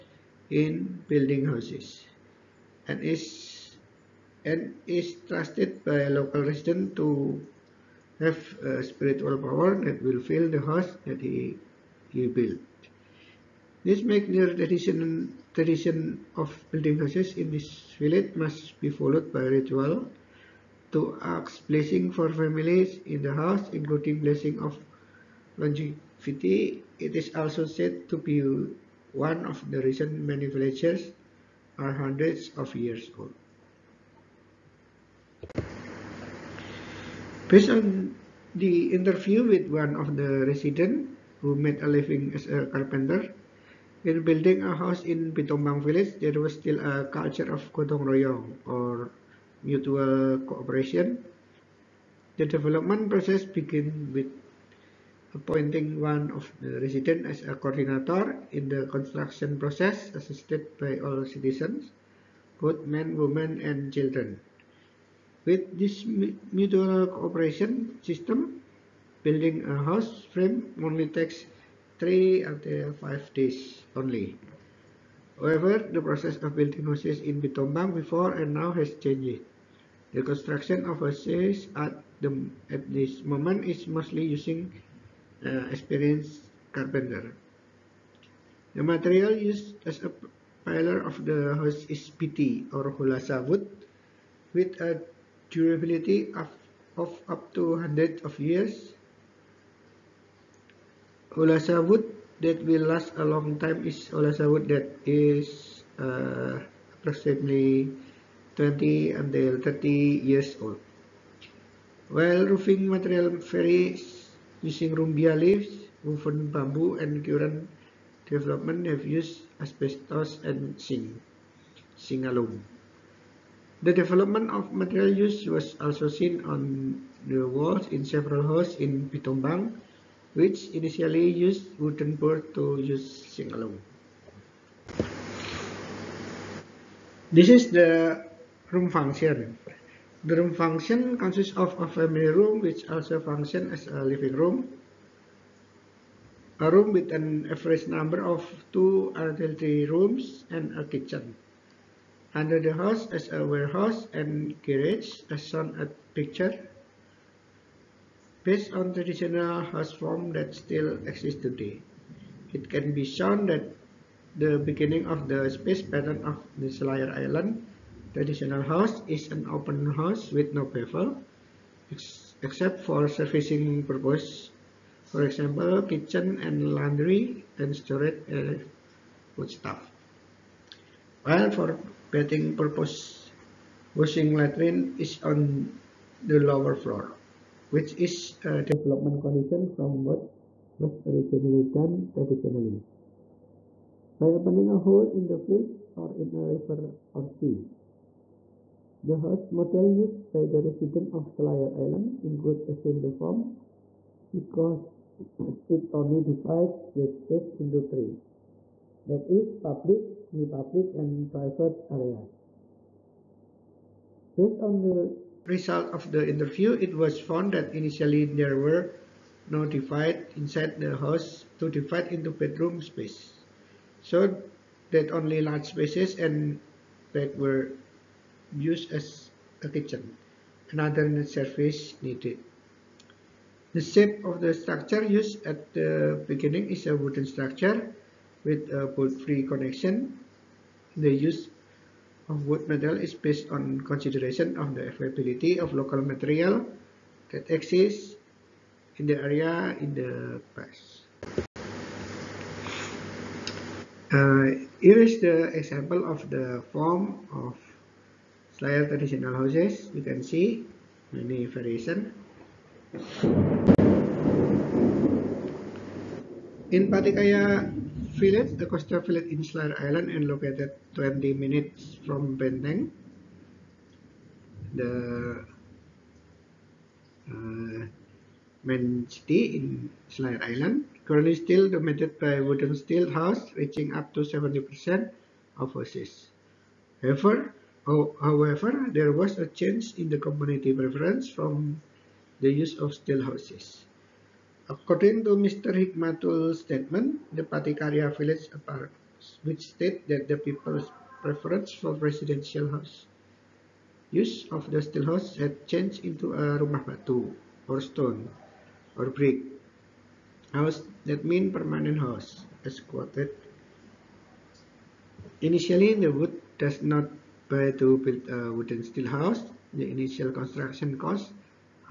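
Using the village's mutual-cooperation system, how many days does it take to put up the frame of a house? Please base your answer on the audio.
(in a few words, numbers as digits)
3 to 5 days.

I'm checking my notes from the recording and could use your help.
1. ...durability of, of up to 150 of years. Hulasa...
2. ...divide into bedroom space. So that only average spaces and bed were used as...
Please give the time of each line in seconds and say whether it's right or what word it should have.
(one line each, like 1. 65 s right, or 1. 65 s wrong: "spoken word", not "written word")
1. 95 s wrong: "100", not "150"
2. 221 s wrong: "large", not "average".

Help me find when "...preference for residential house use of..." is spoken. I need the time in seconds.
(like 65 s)
301 s.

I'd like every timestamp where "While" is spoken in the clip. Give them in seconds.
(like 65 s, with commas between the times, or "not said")
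112 s, 181 s.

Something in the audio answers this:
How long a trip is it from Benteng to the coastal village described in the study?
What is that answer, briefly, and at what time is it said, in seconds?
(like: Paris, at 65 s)
20 minutes, at 270 s.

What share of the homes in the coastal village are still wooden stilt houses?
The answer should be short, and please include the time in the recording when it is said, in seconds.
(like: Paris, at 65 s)
70%, at 284 s.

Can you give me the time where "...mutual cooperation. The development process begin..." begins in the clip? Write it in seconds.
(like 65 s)
49 s.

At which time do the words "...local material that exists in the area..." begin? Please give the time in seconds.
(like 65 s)
245 s.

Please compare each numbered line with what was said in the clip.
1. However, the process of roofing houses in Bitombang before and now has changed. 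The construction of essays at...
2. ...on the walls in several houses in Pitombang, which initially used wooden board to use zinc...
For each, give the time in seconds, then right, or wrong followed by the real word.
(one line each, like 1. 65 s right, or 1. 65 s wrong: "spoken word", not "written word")
1. 75 s wrong: "building", not "roofing"
2. 126 s right.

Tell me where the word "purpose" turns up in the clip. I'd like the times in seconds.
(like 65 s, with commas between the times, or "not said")
173 s, 182 s.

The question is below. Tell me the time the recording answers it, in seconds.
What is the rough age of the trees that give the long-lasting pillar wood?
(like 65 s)
108 s.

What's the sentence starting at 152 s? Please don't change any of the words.
Under the house is a warehouse and garage as shown at picture.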